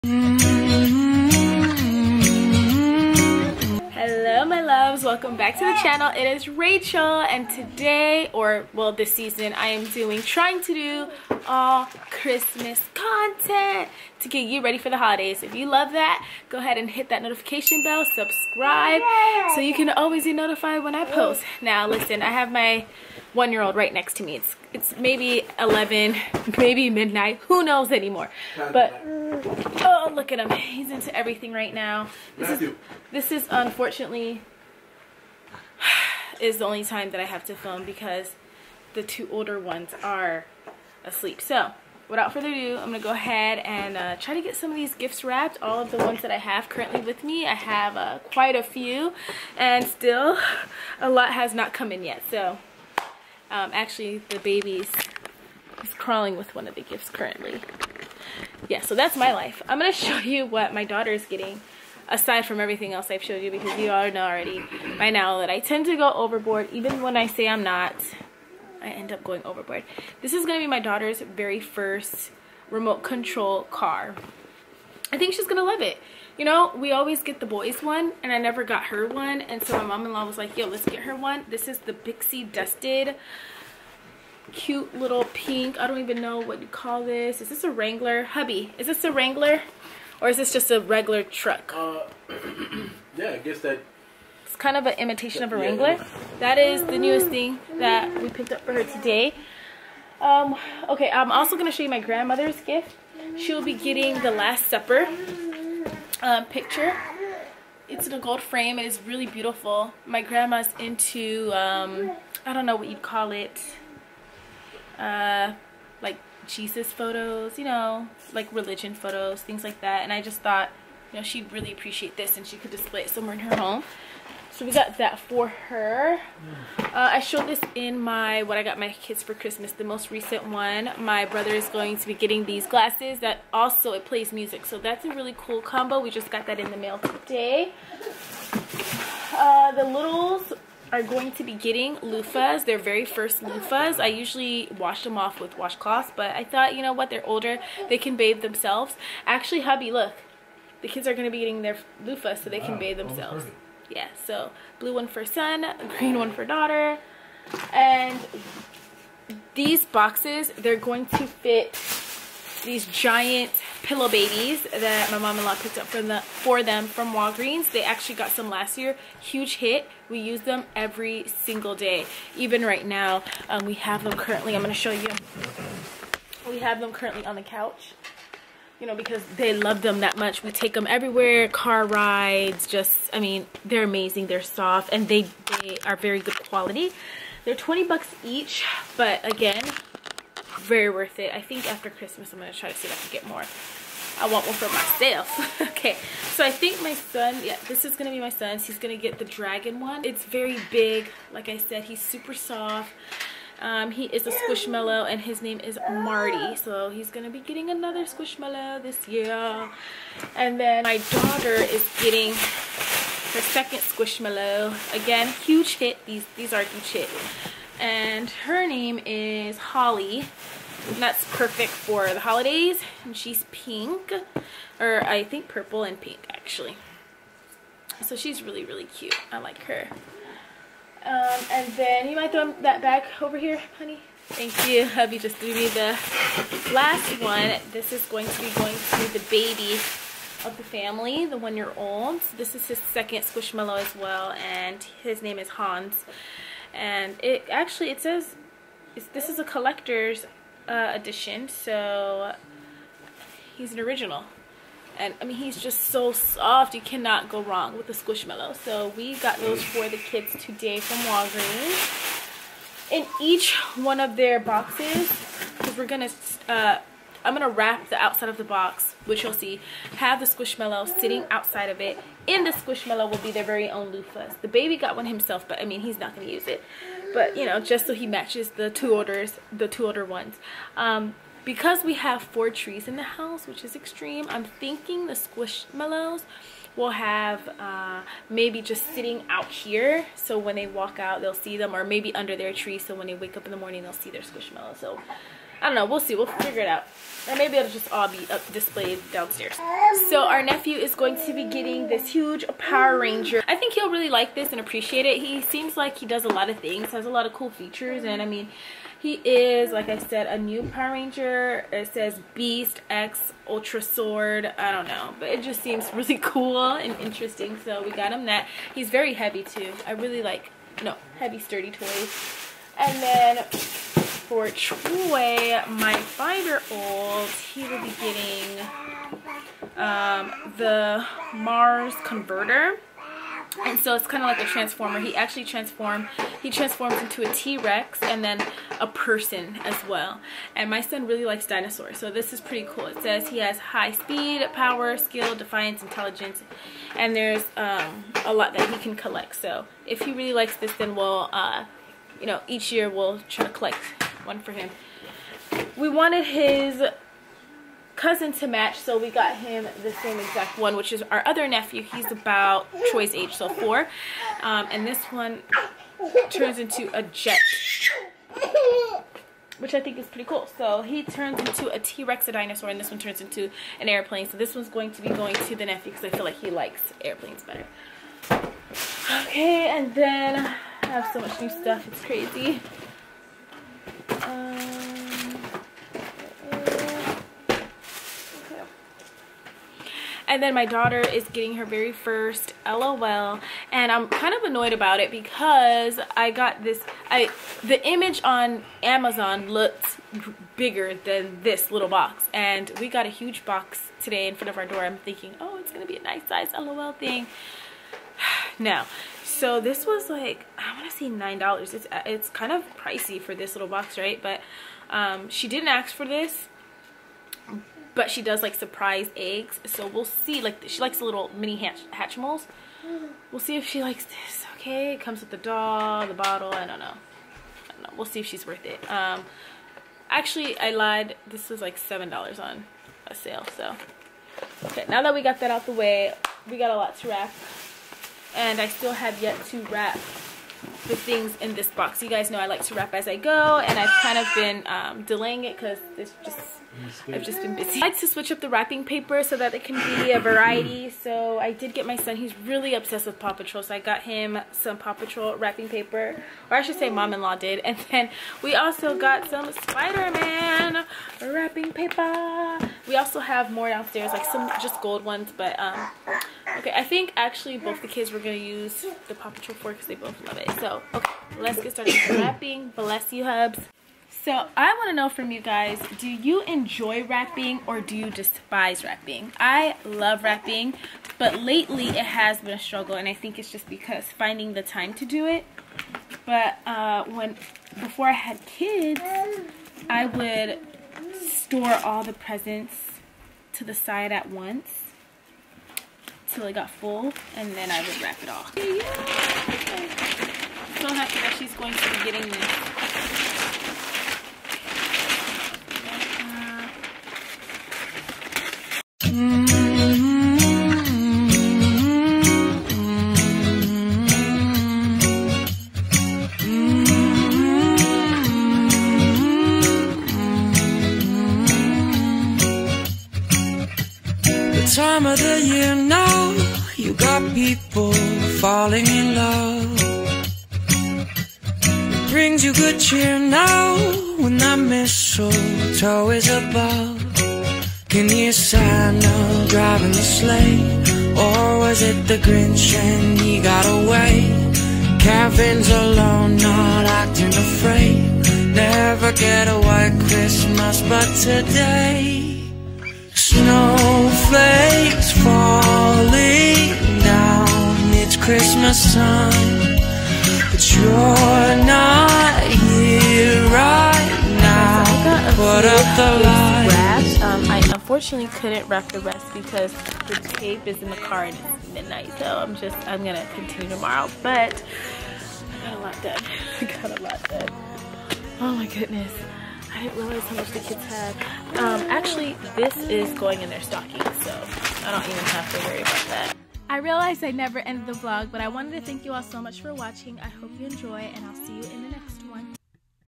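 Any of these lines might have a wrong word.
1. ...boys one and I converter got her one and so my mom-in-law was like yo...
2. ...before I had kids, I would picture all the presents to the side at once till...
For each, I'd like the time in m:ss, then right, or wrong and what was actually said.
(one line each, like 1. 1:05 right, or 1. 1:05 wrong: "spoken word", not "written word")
1. 1:17 wrong: "never", not "converter"
2. 8:07 wrong: "store", not "picture".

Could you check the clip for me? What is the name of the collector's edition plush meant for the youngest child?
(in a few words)
Hans.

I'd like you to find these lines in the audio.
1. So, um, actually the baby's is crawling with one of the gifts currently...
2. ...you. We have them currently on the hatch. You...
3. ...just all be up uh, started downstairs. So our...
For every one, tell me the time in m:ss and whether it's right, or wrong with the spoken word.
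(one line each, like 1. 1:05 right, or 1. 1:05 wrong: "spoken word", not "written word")
1. 0:52 right
2. 2:54 wrong: "couch", not "hatch"
3. 4:57 wrong: "displayed", not "started".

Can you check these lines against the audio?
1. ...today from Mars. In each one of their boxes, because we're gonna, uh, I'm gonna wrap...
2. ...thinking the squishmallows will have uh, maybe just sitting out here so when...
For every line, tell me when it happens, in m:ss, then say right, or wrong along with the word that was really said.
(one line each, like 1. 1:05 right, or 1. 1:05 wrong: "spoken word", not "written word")
1. 4:20 wrong: "Walgreens", not "Mars"
2. 4:44 right.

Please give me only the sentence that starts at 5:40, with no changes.
And my son really likes dinosaurs, so this is pretty cool.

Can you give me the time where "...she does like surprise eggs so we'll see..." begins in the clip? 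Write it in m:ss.
6:58.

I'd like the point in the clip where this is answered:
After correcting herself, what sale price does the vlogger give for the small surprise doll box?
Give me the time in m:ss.
7:11.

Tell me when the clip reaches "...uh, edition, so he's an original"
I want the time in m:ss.
4:10.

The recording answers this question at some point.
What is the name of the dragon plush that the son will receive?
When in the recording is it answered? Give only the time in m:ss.
3:25.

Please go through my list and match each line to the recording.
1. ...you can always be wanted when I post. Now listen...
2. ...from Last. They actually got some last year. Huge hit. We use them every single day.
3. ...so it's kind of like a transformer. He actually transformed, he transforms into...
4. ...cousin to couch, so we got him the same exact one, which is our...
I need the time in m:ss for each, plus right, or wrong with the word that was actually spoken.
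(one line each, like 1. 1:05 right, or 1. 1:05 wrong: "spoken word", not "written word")
1. 0:19 wrong: "notified", not "wanted"
2. 2:46 wrong: "Walgreens", not "Last"
3. 5:33 right
4. 5:57 wrong: "match", not "couch".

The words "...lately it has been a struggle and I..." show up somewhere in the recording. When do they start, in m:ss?
8:01.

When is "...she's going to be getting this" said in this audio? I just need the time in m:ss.
8:21.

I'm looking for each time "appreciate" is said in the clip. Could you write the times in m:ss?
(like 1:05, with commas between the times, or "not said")
2:01, 5:04.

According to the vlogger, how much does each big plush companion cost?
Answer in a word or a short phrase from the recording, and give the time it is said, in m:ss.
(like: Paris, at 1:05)
$20, at 3:07.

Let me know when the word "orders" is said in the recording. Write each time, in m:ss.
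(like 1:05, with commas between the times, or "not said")
4:38.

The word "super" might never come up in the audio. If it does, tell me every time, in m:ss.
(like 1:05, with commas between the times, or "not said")
3:21.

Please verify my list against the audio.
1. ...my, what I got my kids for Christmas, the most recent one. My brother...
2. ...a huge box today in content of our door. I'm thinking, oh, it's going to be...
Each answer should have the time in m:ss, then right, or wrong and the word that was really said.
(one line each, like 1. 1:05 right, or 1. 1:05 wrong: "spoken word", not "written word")
1. 2:07 right
2. 6:43 wrong: "front", not "content".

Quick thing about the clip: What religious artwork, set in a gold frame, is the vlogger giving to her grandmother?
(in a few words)
The Last Supper.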